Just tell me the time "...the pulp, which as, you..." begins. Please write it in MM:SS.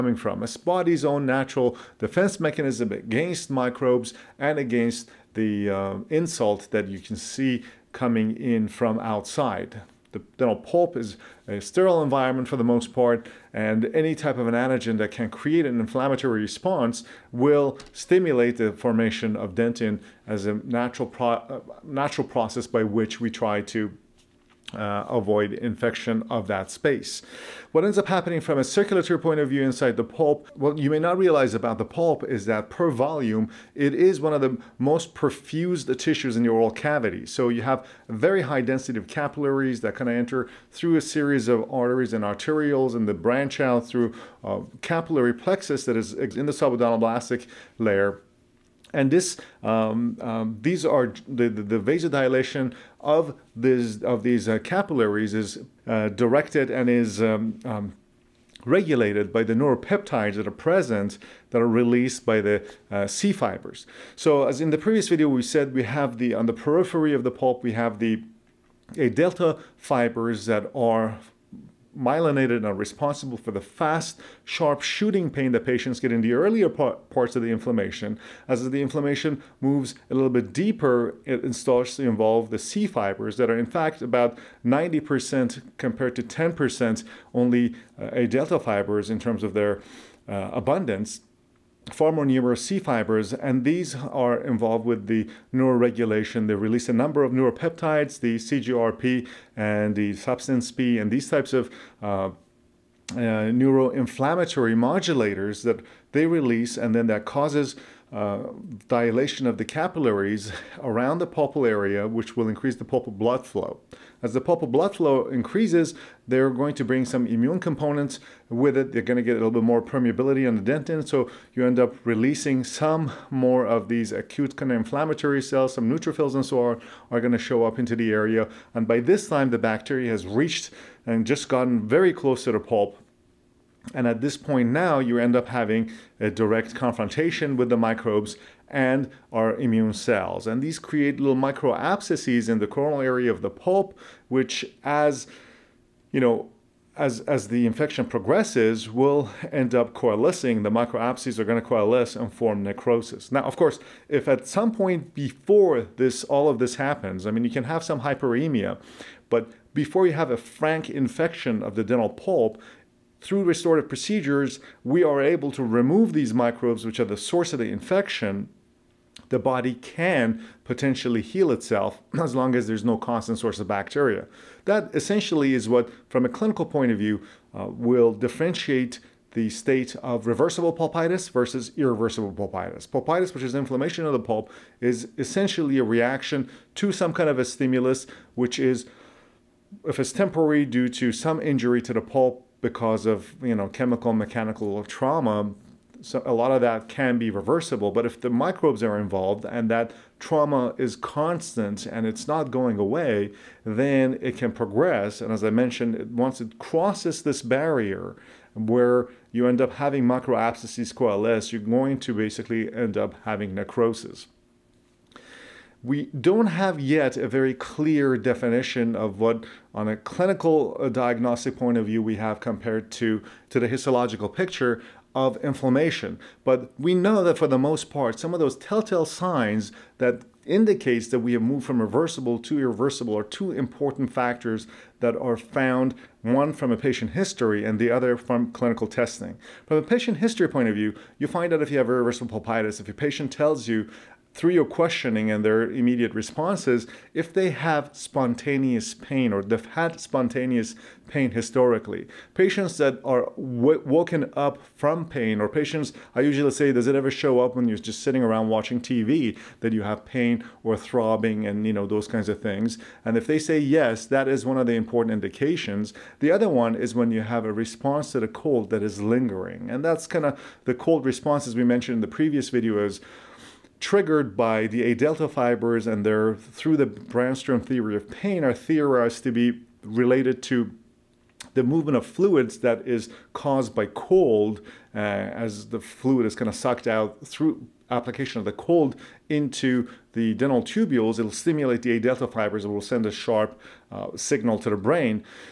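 02:23.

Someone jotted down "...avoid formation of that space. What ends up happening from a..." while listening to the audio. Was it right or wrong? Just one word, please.
wrong.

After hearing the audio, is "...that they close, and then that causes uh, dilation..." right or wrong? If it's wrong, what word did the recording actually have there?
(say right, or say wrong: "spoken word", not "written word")
wrong: "release", not "close".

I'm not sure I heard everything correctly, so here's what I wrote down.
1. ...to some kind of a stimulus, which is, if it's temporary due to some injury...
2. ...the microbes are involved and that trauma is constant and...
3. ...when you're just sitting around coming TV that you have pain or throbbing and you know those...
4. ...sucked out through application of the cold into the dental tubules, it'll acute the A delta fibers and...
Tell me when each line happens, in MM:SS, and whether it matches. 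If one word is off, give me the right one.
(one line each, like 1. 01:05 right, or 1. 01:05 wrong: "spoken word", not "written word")
1. 03:06 right
2. 03:18 right
3. 04:17 wrong: "watching", not "coming"
4. 04:46 wrong: "stimulate", not "acute".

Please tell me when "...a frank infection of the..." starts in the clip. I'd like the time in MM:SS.
02:40.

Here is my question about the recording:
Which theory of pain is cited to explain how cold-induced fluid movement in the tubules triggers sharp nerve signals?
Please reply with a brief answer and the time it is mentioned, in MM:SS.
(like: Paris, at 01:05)
Brännström theory, at 04:36.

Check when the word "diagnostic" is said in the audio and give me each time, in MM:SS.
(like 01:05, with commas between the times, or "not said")
03:40.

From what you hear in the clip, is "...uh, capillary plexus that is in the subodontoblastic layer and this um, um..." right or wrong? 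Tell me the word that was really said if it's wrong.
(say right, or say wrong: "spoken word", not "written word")
right.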